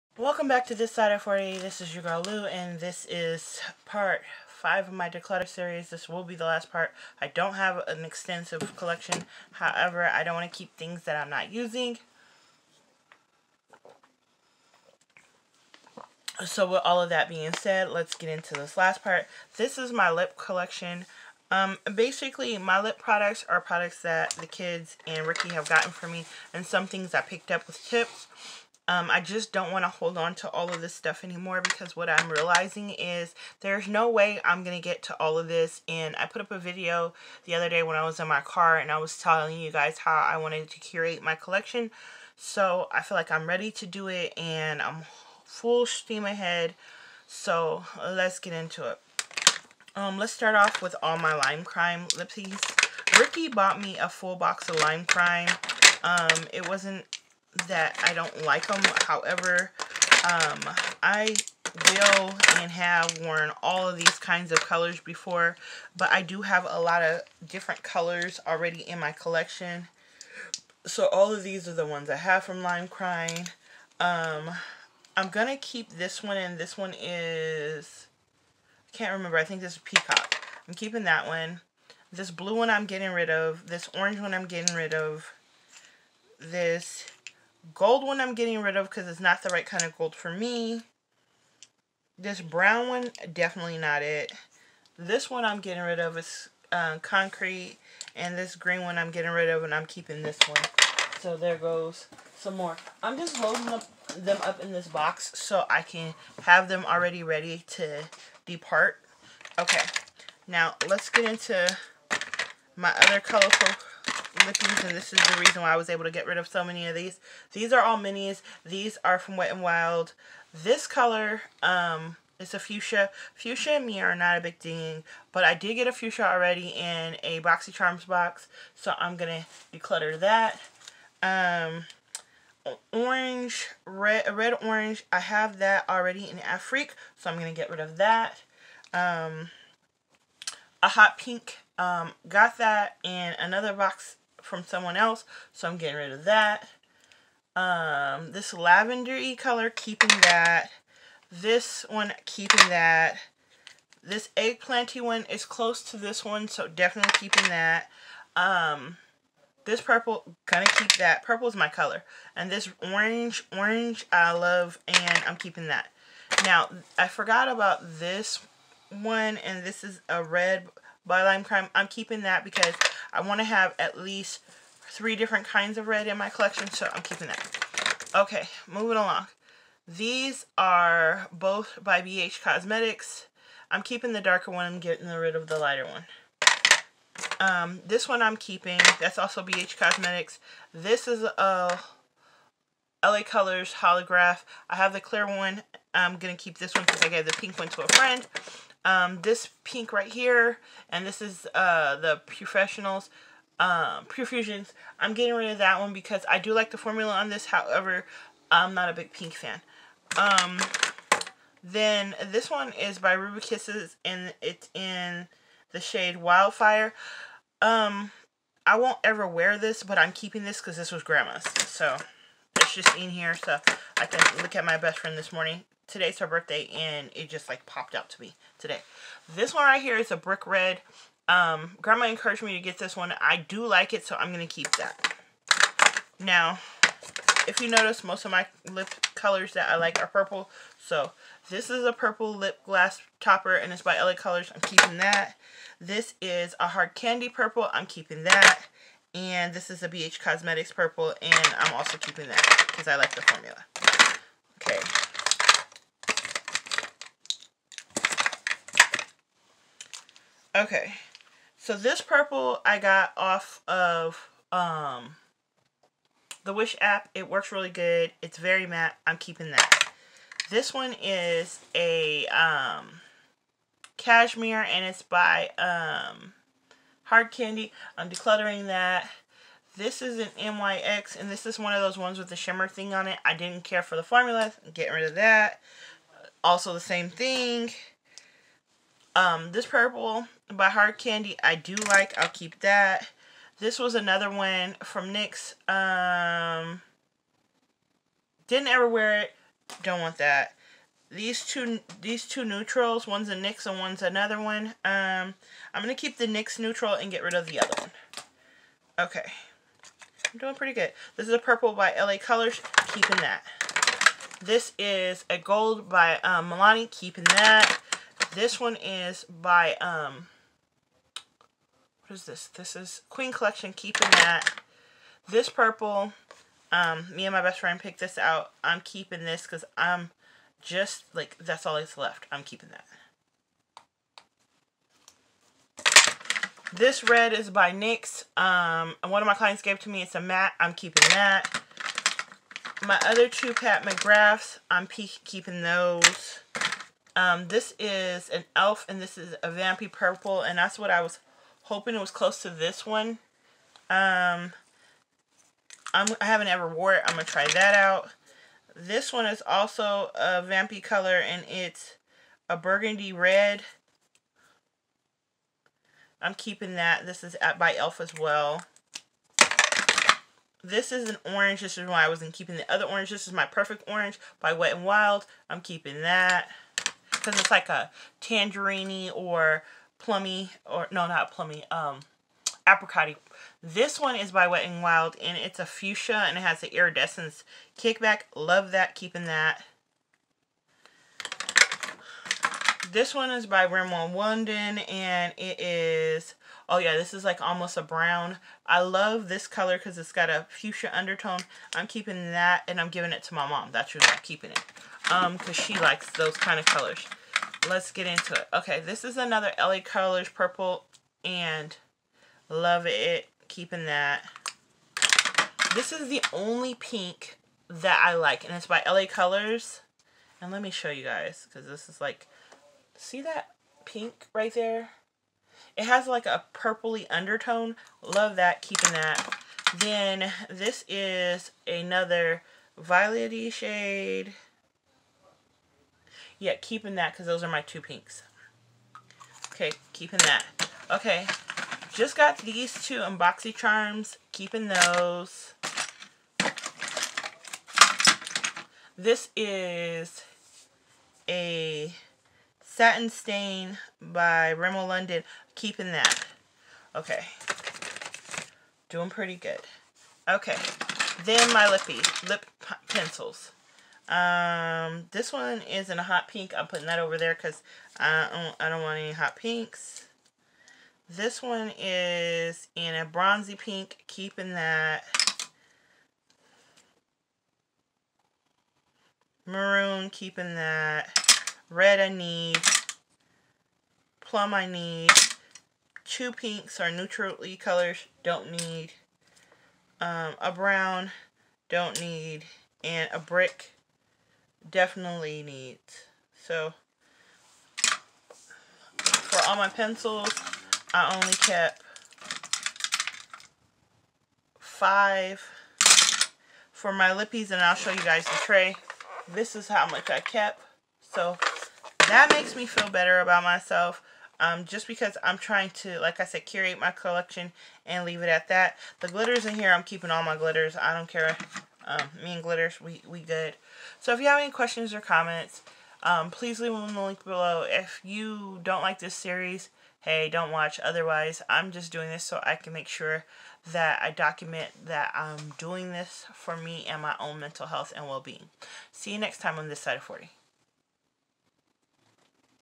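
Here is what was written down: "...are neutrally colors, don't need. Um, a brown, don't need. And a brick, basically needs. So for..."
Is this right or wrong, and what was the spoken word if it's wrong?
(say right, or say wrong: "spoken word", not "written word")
wrong: "definitely", not "basically".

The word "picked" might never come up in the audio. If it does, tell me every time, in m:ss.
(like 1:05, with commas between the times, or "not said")
0:27, 5:27.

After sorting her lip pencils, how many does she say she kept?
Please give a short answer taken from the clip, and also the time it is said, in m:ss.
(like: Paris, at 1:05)
5, at 8:24.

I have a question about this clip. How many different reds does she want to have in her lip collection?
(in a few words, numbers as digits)
3.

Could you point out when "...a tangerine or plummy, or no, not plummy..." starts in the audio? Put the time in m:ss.
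6:17.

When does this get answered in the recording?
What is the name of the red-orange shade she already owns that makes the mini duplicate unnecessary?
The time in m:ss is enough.
2:16.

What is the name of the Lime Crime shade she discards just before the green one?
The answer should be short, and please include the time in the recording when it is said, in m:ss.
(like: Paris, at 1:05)
Concrete, at 1:37.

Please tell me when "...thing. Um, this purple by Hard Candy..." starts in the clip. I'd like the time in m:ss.
4:47.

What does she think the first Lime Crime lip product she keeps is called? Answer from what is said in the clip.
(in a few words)
Peacock.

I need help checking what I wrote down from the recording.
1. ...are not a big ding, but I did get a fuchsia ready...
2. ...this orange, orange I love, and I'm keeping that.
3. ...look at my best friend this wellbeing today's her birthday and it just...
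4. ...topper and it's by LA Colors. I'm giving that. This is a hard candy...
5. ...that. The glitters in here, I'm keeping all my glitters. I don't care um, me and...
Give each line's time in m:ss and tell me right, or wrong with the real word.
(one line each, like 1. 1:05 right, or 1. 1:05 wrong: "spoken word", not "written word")
1. 2:04 wrong: "already", not "ready"
2. 2:42 right
3. 3:44 wrong: "morning", not "wellbeing"
4. 4:03 wrong: "keeping", not "giving"
5. 8:38 right.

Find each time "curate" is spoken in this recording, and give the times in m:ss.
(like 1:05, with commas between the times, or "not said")
0:40, 8:36.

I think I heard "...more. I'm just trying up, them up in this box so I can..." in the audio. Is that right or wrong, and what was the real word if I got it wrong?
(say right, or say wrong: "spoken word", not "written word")
wrong: "loading", not "trying".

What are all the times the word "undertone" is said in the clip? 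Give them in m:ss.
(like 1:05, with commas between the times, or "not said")
6:40, 7:07.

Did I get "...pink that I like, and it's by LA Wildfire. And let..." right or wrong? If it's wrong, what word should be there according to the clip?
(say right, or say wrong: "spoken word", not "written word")
wrong: "Colors", not "Wildfire".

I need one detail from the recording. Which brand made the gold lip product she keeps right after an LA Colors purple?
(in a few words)
Milani.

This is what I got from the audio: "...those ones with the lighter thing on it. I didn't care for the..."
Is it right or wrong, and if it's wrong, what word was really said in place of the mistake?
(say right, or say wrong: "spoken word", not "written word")
wrong: "shimmer", not "lighter".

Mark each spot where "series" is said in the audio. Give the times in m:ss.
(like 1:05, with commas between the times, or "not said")
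0:05, 8:49.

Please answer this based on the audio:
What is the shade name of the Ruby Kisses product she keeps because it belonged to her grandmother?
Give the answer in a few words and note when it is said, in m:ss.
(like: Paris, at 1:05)
Wildfire, at 3:36.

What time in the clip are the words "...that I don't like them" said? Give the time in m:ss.
0:57.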